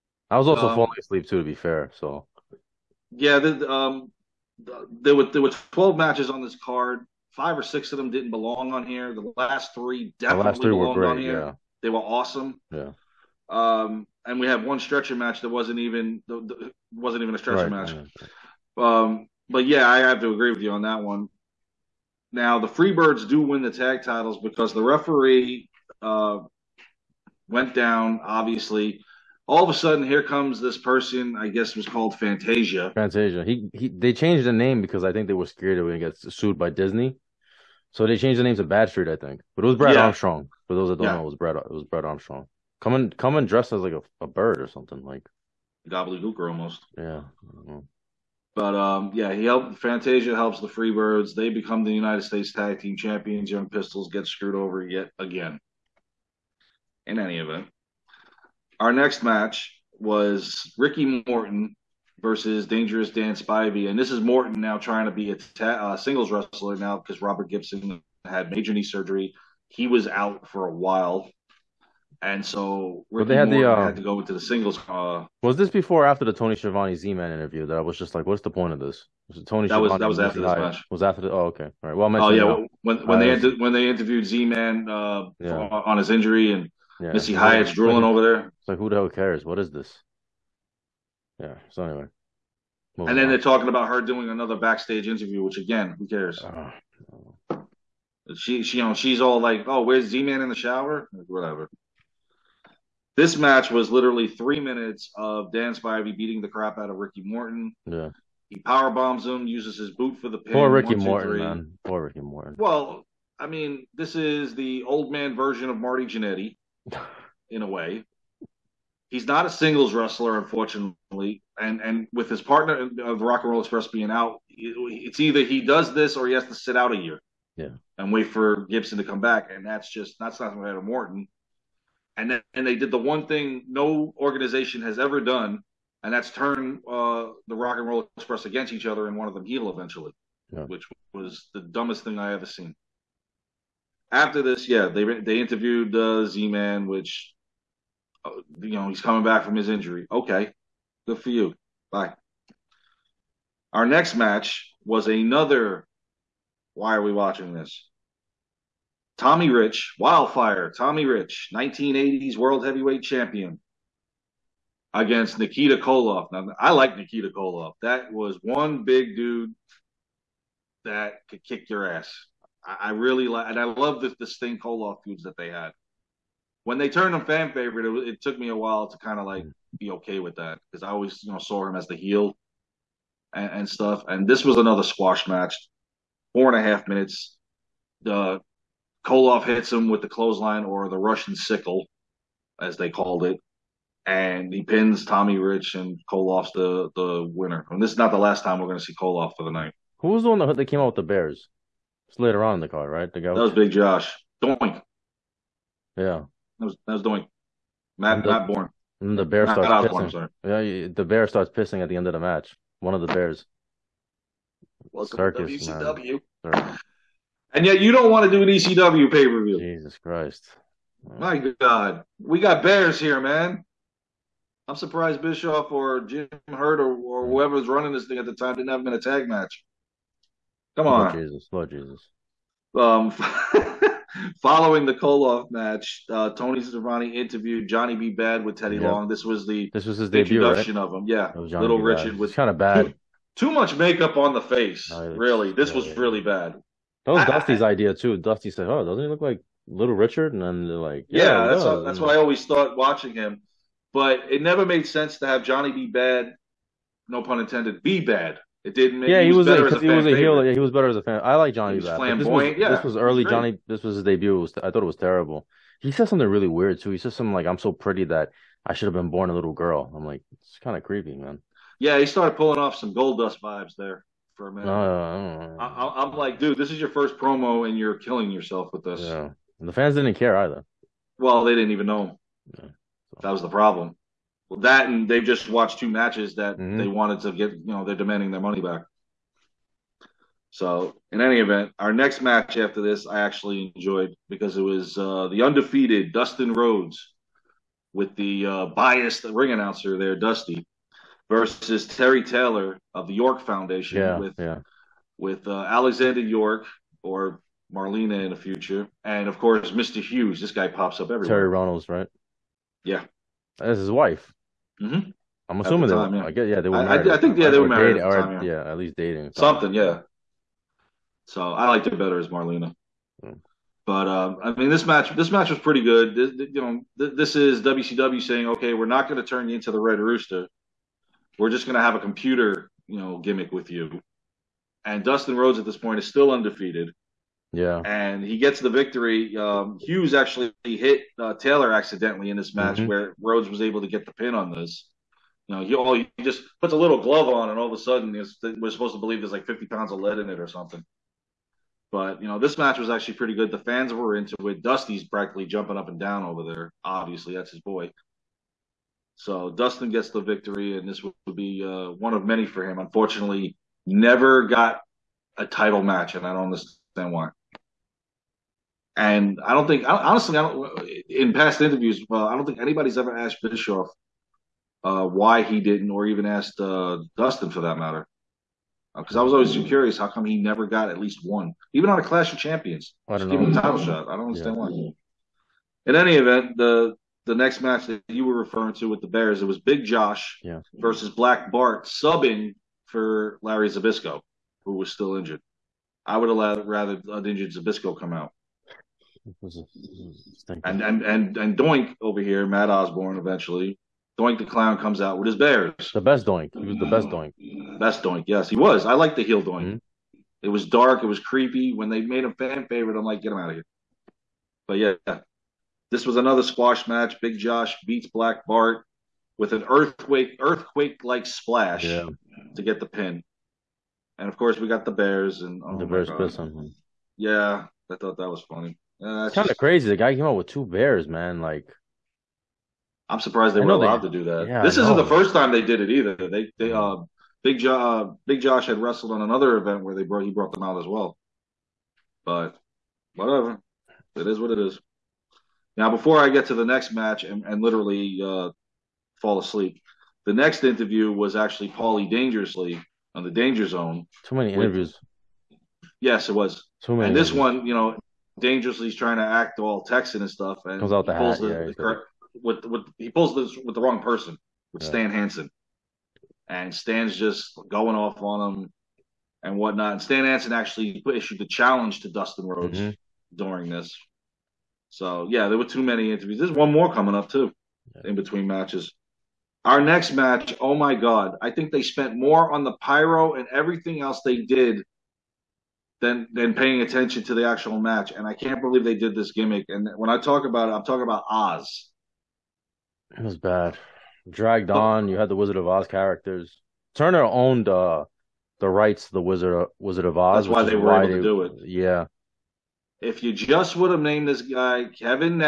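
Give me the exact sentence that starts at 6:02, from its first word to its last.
Unfortunately, never got a title match, and I don't understand why.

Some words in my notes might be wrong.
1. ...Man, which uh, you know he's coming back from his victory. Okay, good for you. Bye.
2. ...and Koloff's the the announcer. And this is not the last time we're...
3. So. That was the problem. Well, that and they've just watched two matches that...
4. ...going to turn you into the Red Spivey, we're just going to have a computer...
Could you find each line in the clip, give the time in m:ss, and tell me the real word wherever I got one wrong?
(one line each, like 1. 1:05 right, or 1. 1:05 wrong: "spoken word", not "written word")
1. 2:26 wrong: "injury", not "victory"
2. 3:15 wrong: "winner", not "announcer"
3. 4:42 right
4. 5:29 wrong: "Rooster", not "Spivey".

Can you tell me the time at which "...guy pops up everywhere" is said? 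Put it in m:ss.
5:10.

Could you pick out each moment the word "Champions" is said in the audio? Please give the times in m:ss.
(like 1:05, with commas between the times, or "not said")
0:52, 2:43, 6:22.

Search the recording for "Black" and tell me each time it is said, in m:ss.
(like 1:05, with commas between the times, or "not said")
6:31, 6:58.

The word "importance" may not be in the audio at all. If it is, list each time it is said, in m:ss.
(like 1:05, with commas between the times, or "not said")
not said.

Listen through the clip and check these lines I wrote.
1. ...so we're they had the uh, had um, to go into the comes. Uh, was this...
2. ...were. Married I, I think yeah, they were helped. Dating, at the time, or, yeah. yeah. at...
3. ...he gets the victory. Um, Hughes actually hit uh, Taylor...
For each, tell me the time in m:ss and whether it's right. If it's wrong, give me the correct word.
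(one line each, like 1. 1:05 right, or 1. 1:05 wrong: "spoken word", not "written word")
1. 1:12 wrong: "singles", not "comes"
2. 5:16 wrong: "married", not "helped"
3. 5:38 right.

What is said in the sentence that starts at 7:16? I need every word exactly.
They they uh, Big Josh uh, Big Josh had wrestled on another event where they brought he brought them out as well.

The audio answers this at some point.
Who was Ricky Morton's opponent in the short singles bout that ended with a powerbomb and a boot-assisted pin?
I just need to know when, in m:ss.
1:02.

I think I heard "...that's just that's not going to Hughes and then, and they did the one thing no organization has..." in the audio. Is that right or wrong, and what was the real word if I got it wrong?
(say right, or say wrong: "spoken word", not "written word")
wrong: "Morton", not "Hughes".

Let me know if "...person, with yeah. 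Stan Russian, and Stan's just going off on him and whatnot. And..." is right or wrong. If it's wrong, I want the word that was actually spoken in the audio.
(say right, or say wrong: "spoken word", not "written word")
wrong: "Hansen", not "Russian".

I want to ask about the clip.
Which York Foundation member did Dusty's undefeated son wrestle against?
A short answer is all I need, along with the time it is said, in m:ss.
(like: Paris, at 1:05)
Terry Taylor, at 5:01.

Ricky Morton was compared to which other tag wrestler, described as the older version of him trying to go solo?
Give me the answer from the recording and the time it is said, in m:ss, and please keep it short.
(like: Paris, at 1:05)
Marty Jannetty, at 1:55.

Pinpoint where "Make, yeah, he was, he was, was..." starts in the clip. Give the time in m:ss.
4:18.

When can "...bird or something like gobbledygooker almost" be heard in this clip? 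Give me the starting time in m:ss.
0:44.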